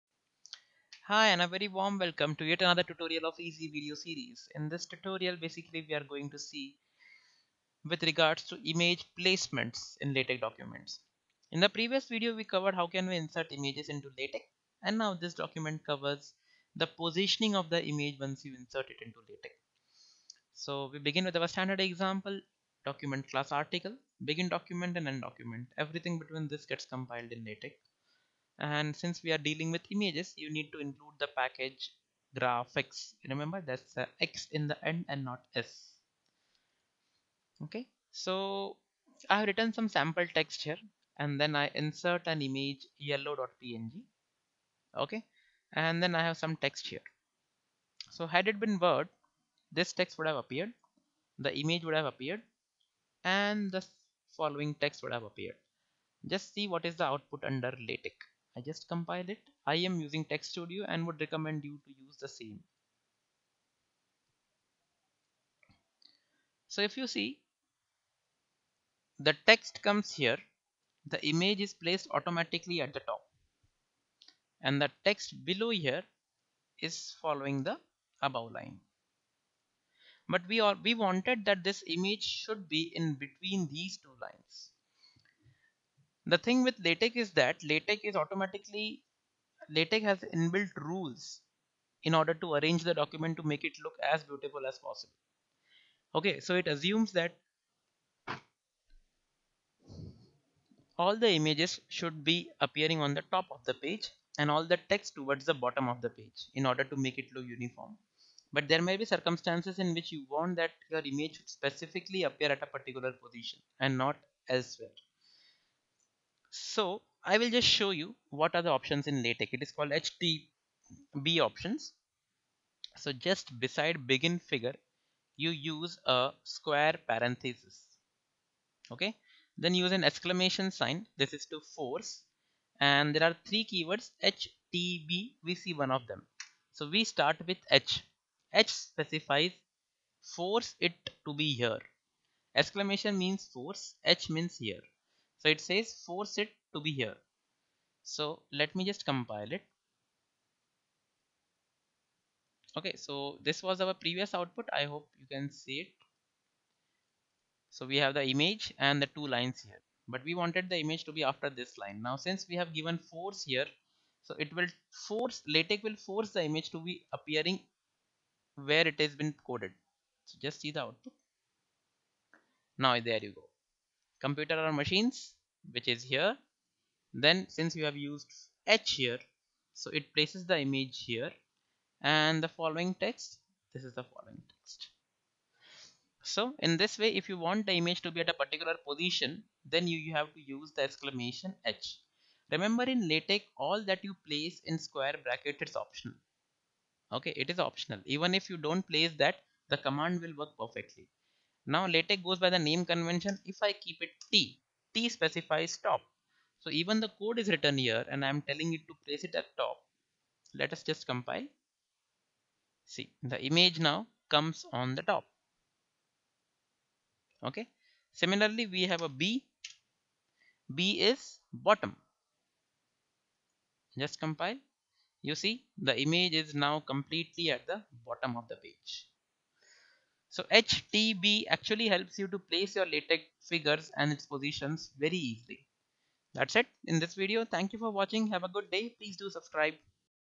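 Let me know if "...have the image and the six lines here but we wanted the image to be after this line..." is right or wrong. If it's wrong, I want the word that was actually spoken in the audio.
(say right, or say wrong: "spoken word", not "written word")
wrong: "two", not "six".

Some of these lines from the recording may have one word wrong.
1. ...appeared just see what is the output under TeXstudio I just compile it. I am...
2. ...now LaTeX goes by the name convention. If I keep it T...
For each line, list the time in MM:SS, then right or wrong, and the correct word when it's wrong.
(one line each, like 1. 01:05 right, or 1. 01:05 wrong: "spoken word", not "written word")
1. 00:55 wrong: "LaTeX", not "TeXstudio"
2. 03:21 right.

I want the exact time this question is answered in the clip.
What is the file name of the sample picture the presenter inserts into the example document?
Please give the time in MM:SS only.
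00:42.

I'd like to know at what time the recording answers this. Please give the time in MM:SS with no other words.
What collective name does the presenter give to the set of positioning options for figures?
01:59.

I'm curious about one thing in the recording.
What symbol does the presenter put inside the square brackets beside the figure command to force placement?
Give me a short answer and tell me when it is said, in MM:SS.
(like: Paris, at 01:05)
exclamation sign, at 02:10.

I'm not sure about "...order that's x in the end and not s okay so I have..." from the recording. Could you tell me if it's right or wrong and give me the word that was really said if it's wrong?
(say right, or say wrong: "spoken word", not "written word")
wrong: "remember", not "order".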